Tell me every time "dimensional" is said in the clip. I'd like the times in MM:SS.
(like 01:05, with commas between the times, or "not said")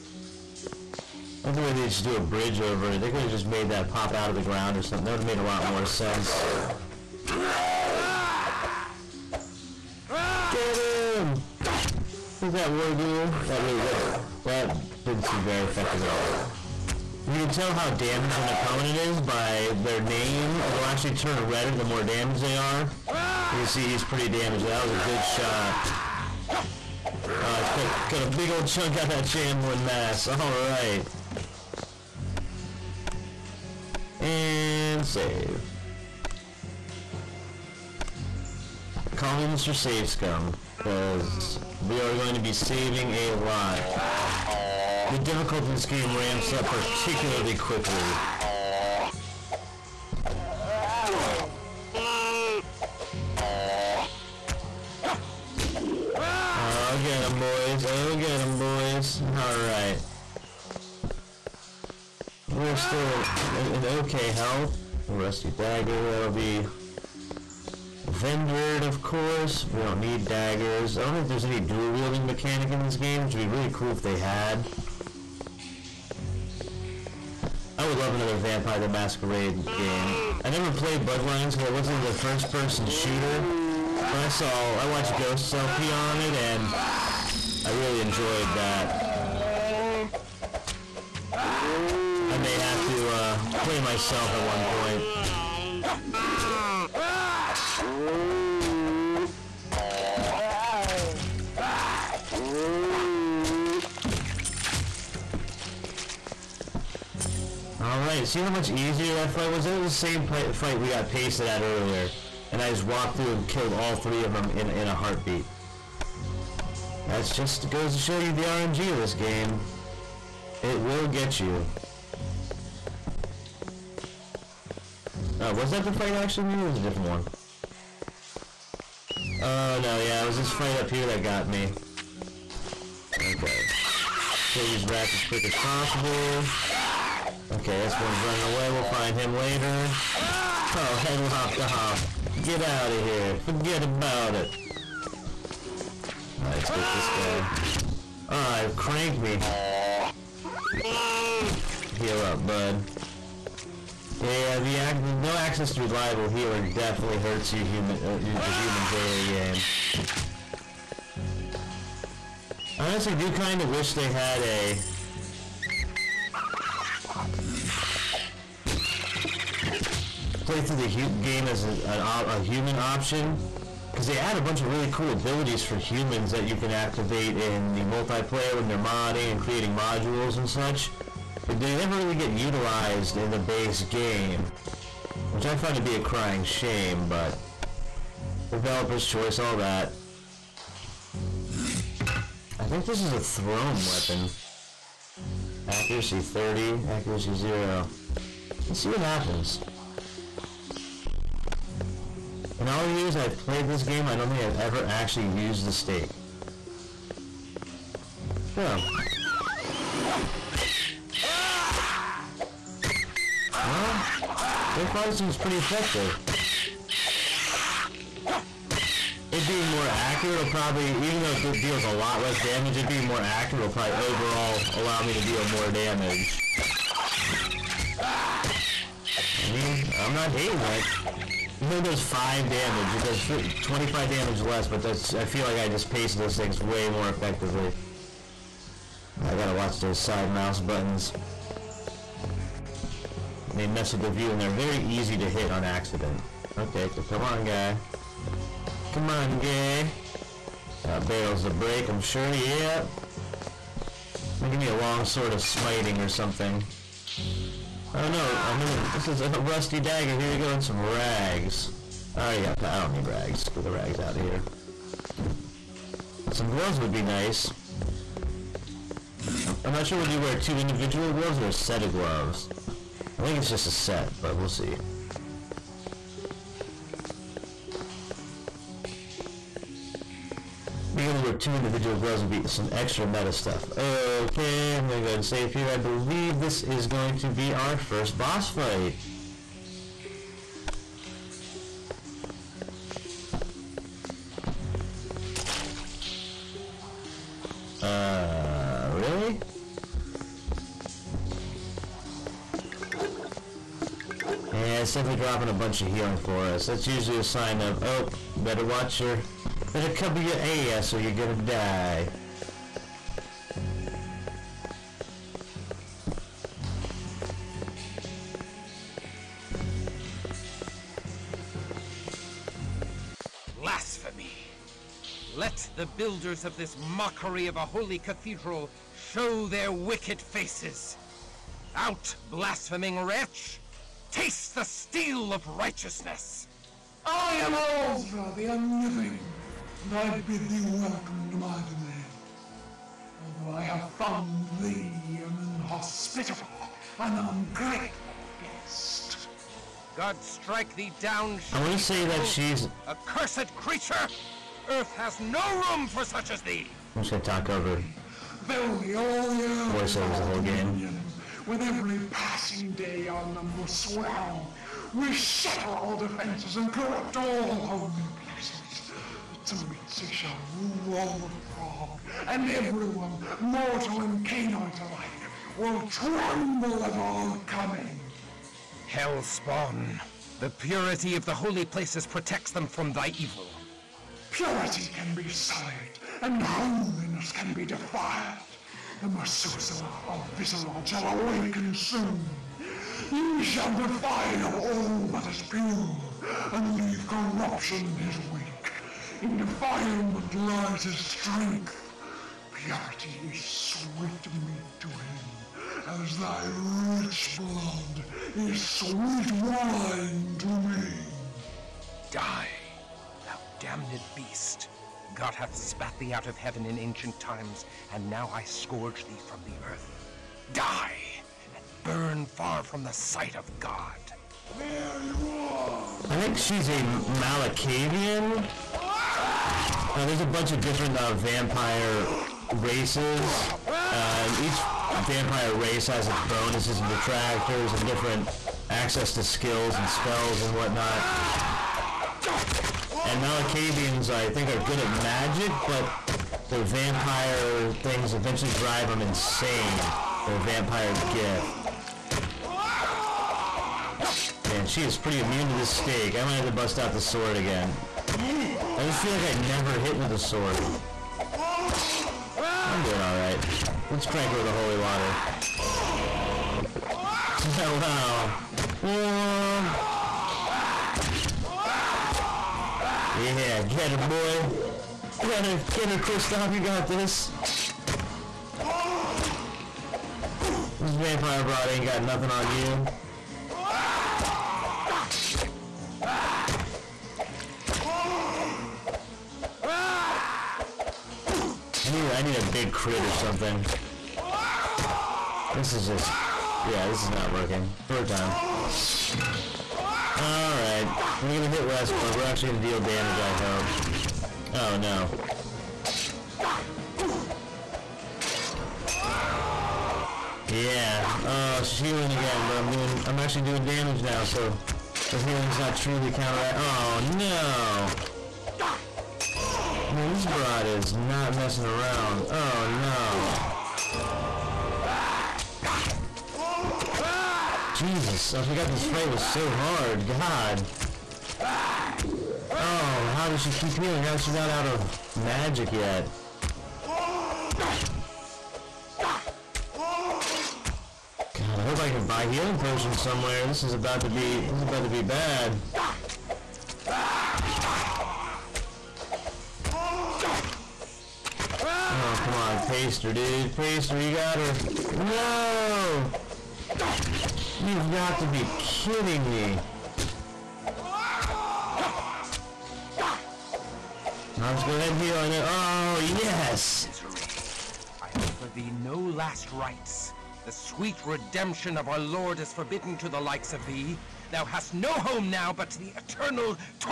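not said.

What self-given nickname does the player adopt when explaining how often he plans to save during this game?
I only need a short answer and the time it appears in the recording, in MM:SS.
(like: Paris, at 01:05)
Mr. Save Scum, at 00:39.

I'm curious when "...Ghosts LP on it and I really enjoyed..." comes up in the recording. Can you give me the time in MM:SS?
01:25.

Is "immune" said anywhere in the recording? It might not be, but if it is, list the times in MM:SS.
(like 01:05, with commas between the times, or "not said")
07:35.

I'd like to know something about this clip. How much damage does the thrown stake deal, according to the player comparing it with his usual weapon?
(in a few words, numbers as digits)
5.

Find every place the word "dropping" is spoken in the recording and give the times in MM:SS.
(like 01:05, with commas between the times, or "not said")
05:05.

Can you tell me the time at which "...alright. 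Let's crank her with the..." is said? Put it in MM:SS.
07:42.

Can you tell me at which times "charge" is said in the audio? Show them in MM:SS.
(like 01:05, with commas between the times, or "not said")
not said.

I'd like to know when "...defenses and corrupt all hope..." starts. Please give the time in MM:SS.
06:05.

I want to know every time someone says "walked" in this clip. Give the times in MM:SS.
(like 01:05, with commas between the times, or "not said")
01:52.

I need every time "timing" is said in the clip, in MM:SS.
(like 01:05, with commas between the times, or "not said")
not said.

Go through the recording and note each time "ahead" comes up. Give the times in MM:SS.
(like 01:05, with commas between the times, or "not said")
04:45, 09:24.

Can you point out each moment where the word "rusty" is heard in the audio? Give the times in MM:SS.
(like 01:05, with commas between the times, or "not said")
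01:05, 04:19.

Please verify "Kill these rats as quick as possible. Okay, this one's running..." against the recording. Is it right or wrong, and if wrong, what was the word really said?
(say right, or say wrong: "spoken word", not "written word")
right.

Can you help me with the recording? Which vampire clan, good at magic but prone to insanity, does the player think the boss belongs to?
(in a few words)
Malkavian.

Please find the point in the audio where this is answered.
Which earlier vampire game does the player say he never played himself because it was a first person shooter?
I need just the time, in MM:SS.
01:21.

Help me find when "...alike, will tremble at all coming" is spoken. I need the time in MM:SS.
06:14.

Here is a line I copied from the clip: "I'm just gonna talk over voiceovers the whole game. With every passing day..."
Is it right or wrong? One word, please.
right.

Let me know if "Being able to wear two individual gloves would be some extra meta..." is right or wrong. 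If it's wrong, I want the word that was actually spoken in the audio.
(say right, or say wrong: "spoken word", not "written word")
right.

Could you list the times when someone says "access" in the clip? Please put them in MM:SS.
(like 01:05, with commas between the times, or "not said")
02:35, 07:18.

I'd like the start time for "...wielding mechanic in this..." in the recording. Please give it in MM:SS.
01:11.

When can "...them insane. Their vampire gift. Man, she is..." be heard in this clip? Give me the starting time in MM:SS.
07:28.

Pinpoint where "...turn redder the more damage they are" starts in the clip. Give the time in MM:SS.
00:21.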